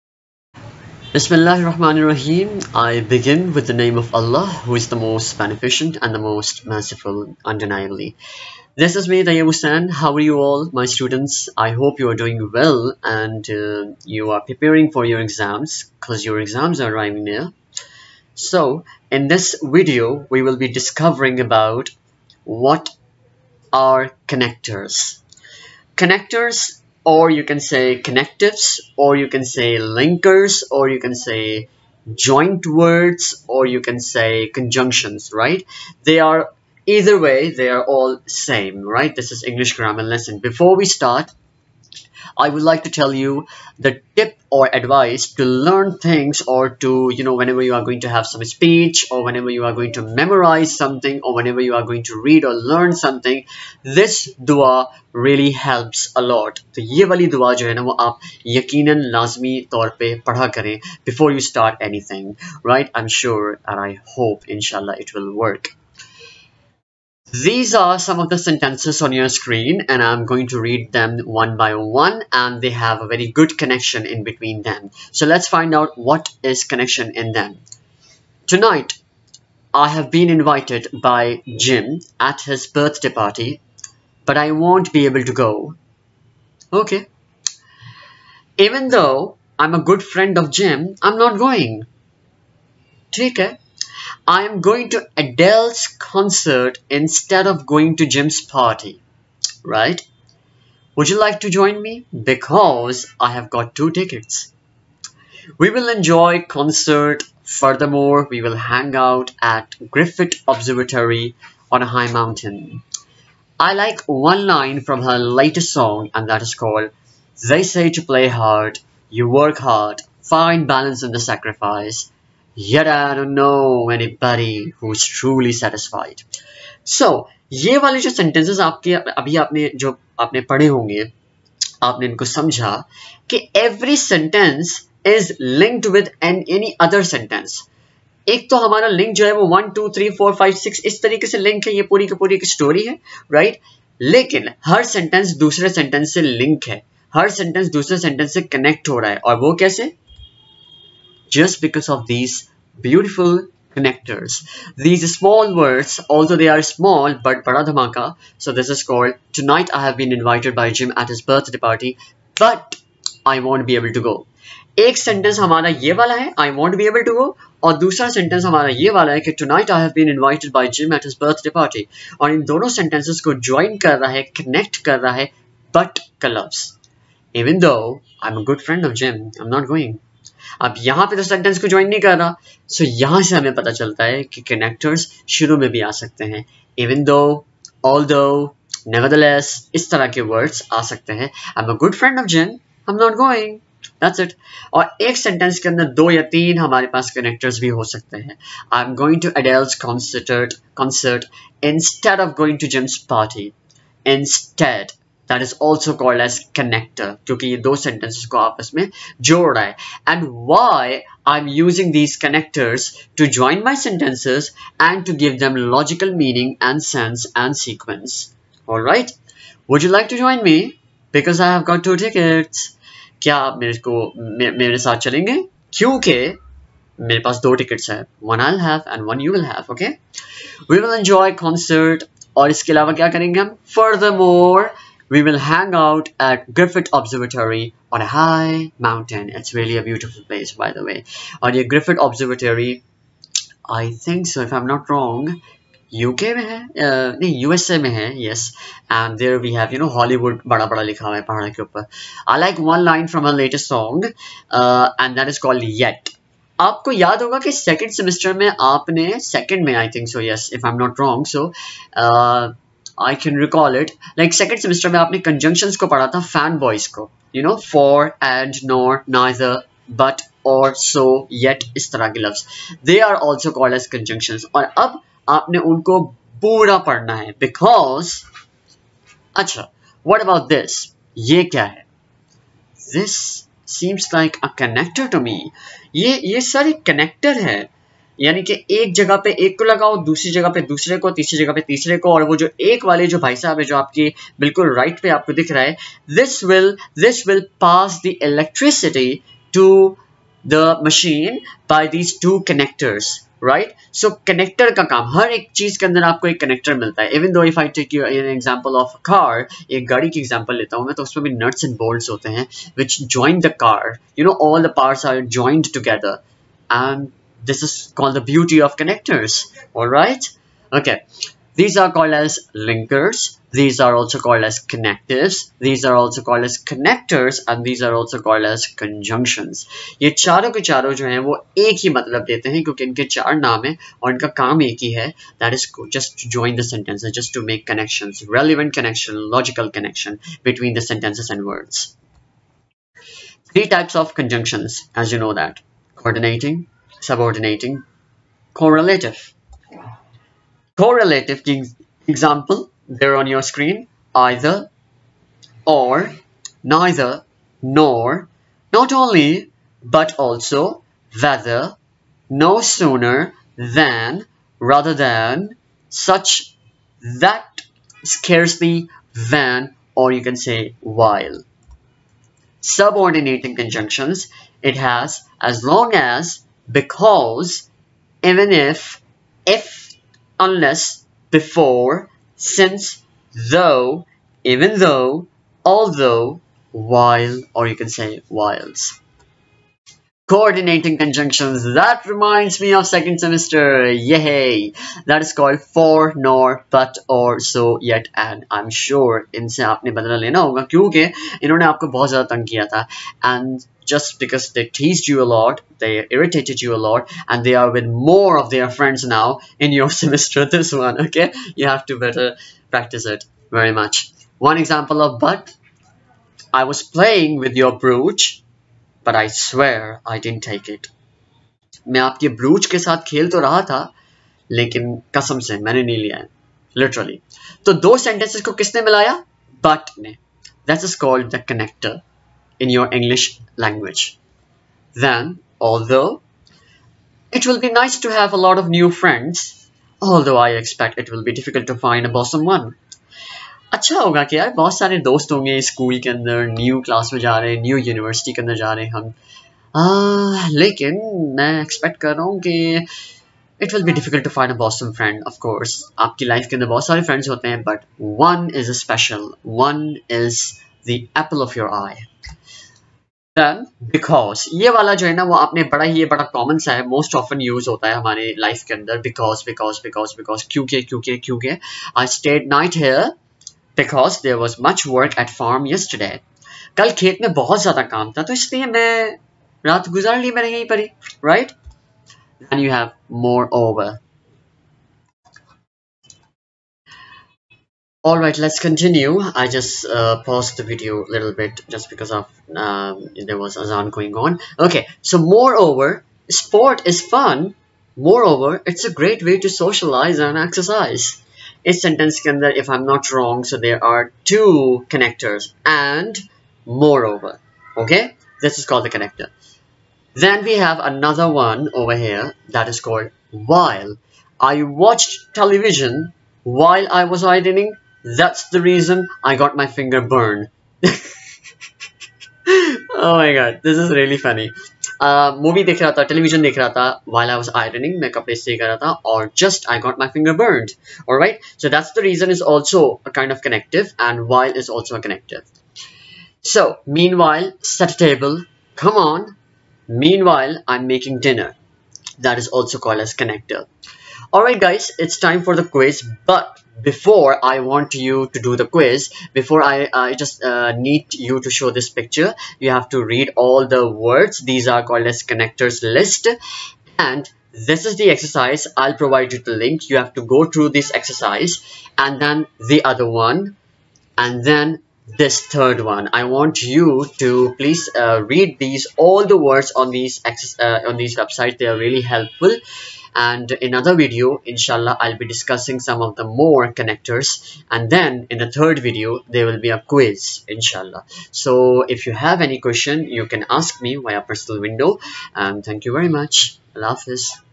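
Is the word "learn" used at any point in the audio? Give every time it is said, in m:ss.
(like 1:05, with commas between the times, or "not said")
0:45, 0:52.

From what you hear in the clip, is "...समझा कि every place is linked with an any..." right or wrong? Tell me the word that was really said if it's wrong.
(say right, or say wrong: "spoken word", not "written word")
wrong: "sentence", not "place".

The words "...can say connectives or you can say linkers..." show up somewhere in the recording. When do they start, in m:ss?
0:27.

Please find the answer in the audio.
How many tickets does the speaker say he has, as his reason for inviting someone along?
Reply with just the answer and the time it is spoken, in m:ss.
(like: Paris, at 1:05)
2, at 1:43.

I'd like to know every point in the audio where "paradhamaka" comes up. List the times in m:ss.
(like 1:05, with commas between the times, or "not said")
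2:37.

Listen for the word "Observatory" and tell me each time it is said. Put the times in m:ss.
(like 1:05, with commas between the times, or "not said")
1:50, 3:56, 4:02.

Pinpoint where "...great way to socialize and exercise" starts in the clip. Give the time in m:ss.
8:18.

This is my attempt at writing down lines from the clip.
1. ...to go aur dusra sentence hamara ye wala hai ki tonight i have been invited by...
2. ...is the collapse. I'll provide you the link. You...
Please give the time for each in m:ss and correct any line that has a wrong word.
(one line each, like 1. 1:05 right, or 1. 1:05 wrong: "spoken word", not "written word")
1. 2:47 right
2. 9:17 wrong: "exercise", not "collapse".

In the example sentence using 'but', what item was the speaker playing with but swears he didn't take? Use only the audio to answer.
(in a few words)
Brooch.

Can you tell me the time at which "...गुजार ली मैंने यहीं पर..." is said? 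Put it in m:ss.
7:59.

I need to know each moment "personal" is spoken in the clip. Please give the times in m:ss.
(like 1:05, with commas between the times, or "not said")
9:44.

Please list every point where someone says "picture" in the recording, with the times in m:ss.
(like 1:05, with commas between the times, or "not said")
9:11.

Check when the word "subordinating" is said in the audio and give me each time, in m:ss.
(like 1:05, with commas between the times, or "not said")
5:47, 6:12.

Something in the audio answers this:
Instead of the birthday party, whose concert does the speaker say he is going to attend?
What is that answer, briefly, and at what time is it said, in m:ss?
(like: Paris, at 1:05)
Adele, at 1:35.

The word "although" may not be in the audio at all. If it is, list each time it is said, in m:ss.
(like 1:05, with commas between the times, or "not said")
2:36, 6:25, 7:15, 7:19.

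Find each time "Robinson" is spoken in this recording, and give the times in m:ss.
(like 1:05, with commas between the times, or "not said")
not said.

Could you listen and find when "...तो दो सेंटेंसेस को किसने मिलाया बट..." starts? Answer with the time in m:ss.
7:07.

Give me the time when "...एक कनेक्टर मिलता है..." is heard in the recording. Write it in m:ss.
5:06.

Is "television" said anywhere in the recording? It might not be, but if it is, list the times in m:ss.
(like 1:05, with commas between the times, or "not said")
8:35, 8:46.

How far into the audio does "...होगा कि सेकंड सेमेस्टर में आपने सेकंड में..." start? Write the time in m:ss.
4:17.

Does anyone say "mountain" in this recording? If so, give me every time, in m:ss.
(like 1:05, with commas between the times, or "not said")
1:52, 3:58.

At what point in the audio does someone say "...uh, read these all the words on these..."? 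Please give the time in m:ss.
9:27.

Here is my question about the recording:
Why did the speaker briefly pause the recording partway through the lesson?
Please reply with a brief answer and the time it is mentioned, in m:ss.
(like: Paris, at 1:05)
Azan, at 8:13.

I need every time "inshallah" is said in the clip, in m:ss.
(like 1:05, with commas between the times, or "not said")
1:04, 9:34, 9:40.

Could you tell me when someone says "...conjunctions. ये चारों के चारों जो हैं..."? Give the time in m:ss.
5:28.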